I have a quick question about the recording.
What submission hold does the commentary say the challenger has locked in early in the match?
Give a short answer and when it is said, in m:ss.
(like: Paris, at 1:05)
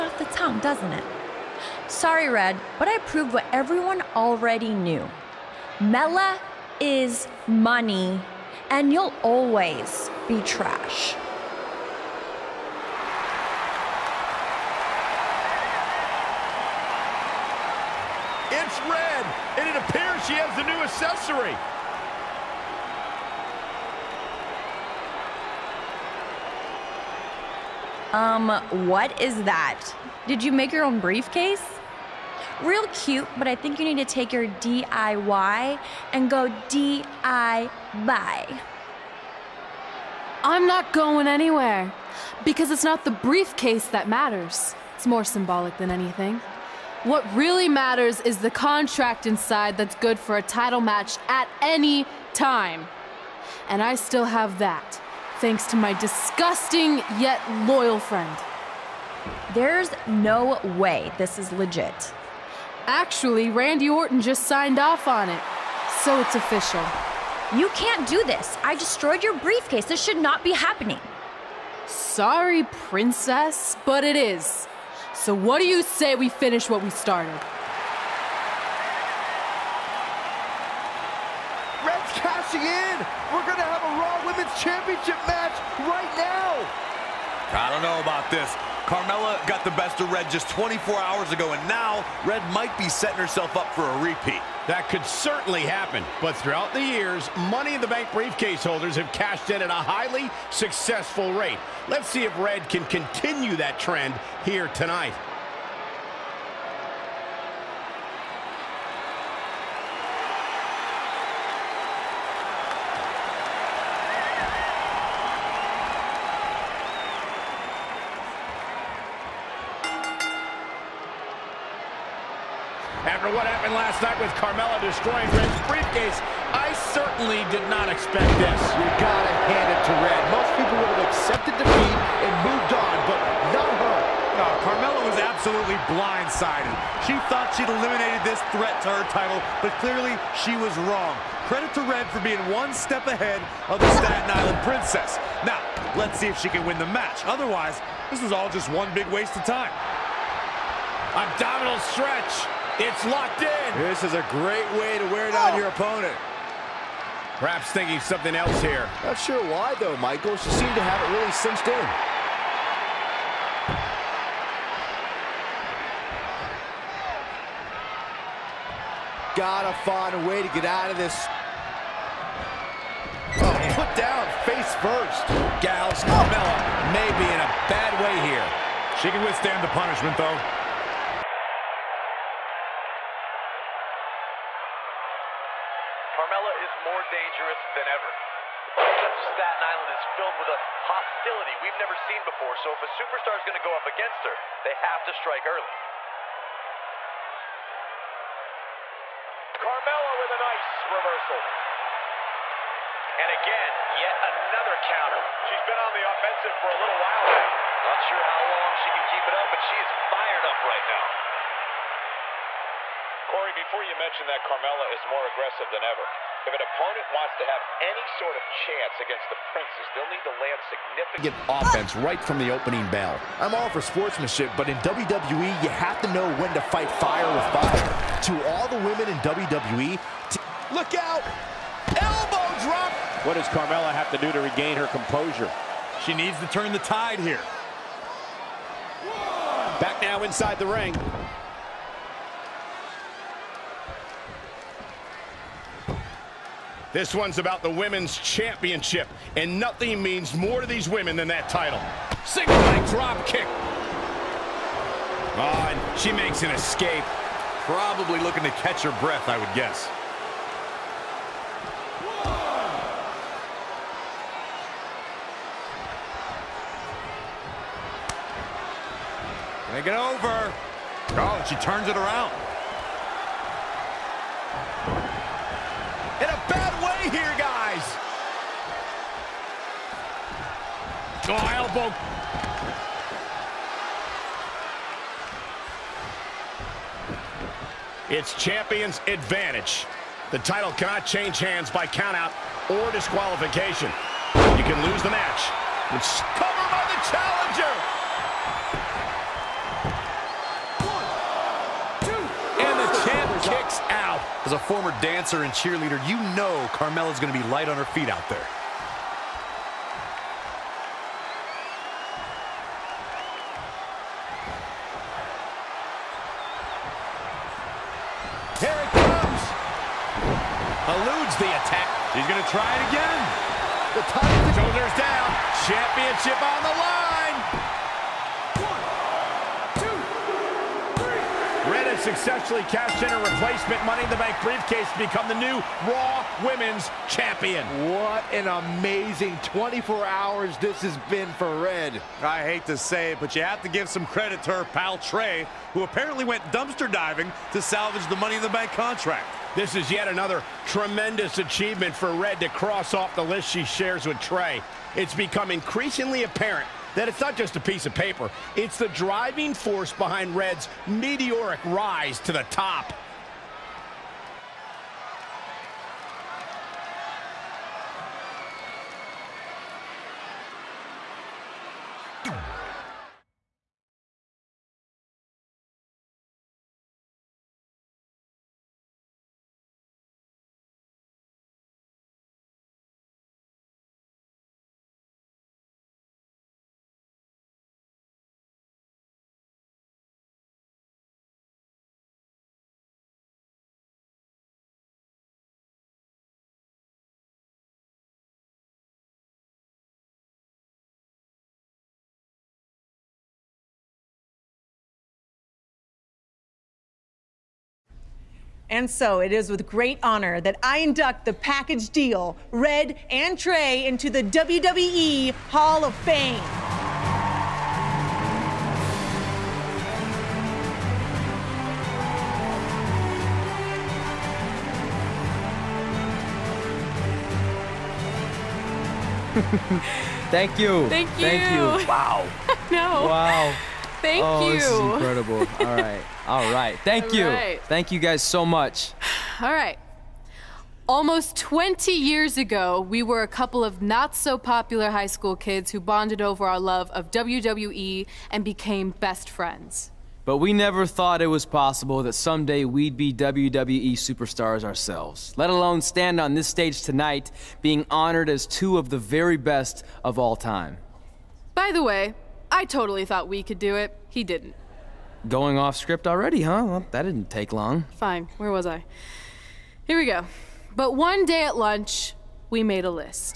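Abdominal stretch, at 2:31.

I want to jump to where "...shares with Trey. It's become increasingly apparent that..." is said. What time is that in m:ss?
5:53.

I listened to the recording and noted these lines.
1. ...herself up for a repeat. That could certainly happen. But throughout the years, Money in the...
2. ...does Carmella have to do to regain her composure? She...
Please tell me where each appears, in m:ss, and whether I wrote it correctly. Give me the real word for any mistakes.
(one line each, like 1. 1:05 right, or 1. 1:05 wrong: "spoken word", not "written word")
1. 1:33 right
2. 3:53 right.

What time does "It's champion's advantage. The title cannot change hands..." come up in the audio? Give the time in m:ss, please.
4:48.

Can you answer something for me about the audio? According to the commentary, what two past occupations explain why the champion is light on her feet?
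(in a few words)
Dancer and cheerleader.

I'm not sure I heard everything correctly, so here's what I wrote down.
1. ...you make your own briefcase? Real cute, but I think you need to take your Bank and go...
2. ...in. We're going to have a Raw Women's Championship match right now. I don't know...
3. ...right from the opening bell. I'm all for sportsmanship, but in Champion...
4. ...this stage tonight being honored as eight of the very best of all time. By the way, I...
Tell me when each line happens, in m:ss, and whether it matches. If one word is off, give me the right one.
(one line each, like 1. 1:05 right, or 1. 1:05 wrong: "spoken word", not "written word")
1. 0:30 wrong: "DIY", not "Bank"
2. 1:22 right
3. 3:41 wrong: "WWE", not "Champion"
4. 7:36 wrong: "two", not "eight".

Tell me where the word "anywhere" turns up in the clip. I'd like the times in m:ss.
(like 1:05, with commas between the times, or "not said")
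0:41.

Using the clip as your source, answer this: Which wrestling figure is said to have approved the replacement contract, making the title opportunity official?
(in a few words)
Randy Orton.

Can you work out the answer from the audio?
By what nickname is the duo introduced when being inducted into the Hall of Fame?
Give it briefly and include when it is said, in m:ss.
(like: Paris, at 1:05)
The package deal, at 6:51.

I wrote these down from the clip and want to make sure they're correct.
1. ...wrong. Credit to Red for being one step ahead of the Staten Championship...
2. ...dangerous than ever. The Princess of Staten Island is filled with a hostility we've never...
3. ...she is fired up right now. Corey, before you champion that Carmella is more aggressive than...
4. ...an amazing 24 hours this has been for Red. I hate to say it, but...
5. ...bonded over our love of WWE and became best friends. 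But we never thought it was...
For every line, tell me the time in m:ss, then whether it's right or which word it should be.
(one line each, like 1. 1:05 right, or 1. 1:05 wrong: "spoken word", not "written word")
1. 2:20 wrong: "Island", not "Championship"
2. 3:07 right
3. 3:29 wrong: "mention", not "champion"
4. 5:38 right
5. 7:25 right.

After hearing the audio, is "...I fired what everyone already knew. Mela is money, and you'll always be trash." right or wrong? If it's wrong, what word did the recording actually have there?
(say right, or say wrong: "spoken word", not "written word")
wrong: "proved", not "fired".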